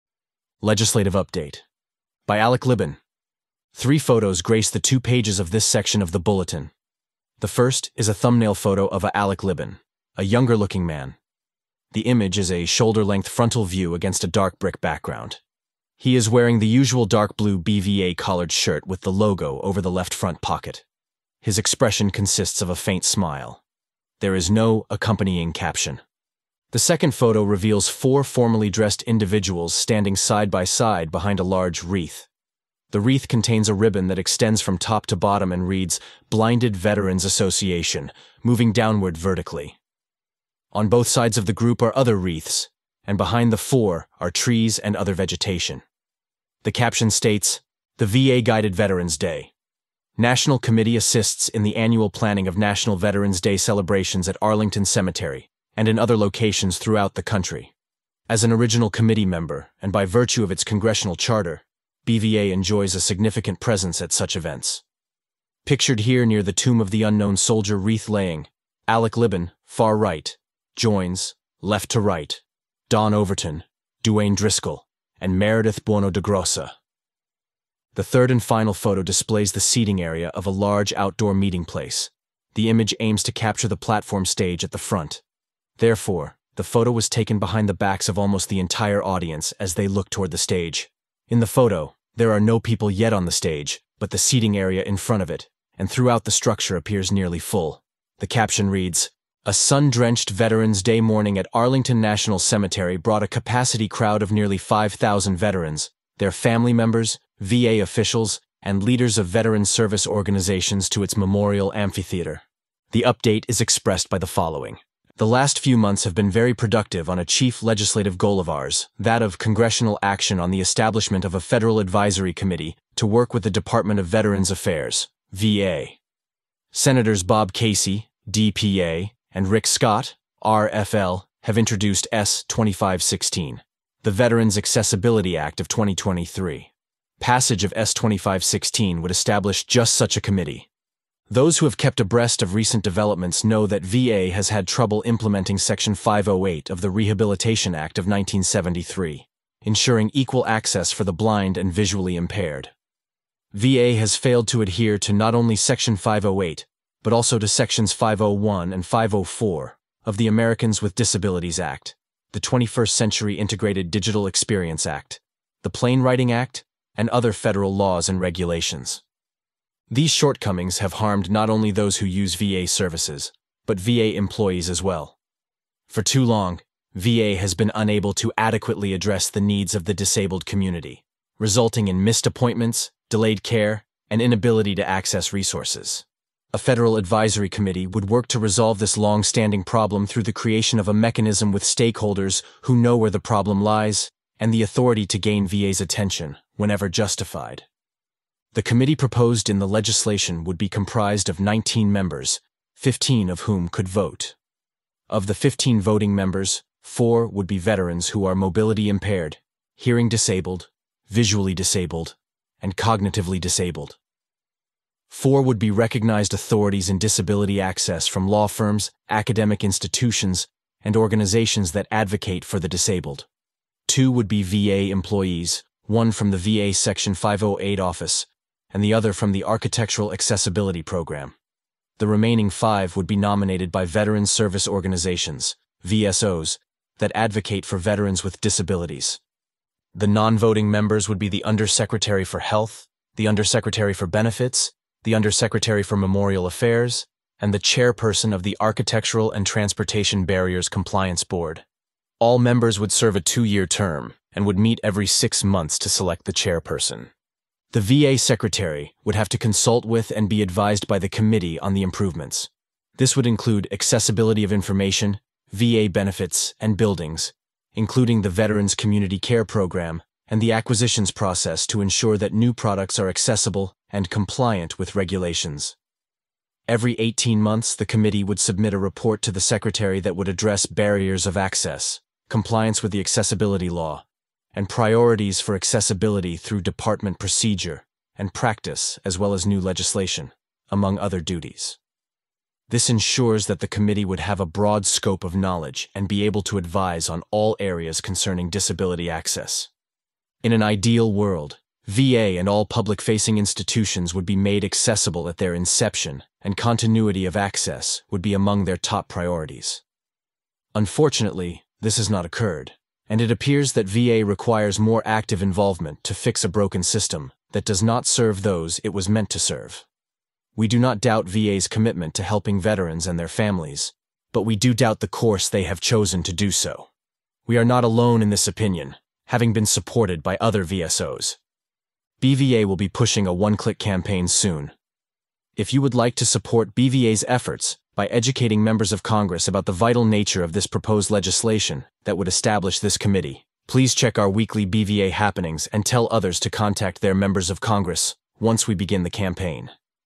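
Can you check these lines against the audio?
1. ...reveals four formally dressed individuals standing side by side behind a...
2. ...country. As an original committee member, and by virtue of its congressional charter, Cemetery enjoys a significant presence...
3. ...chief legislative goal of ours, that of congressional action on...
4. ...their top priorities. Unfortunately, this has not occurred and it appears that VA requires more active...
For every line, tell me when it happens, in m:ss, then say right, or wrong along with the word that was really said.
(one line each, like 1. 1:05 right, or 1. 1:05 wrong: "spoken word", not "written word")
1. 0:27 right
2. 0:57 wrong: "BVA", not "Cemetery"
3. 1:57 right
4. 5:08 right.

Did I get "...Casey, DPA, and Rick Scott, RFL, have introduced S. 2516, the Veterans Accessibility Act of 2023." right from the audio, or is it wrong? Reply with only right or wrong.
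right.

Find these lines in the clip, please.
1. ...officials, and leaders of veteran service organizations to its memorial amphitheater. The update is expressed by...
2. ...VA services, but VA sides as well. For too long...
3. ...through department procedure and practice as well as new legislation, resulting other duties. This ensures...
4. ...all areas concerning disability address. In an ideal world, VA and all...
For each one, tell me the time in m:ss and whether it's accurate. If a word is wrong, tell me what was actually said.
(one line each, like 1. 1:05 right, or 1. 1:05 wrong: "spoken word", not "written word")
1. 1:47 right
2. 2:52 wrong: "employees", not "sides"
3. 4:46 wrong: "among", not "resulting"
4. 4:57 wrong: "access", not "address".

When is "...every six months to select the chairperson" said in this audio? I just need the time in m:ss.
4:14.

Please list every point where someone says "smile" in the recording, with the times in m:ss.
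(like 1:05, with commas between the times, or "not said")
0:23.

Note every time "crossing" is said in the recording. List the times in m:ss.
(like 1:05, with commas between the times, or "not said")
not said.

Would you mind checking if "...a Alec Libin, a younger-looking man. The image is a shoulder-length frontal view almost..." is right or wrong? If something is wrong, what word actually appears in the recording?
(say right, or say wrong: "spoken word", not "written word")
wrong: "against", not "almost".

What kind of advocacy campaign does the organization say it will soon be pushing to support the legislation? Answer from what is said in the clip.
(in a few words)
one-click campaign.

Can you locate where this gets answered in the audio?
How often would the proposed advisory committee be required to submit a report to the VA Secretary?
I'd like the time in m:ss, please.
4:36.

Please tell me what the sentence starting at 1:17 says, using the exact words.
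The third and final photo displays the seating area of a large outdoor meeting place.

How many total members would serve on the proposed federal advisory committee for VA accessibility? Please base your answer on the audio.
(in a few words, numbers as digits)
19.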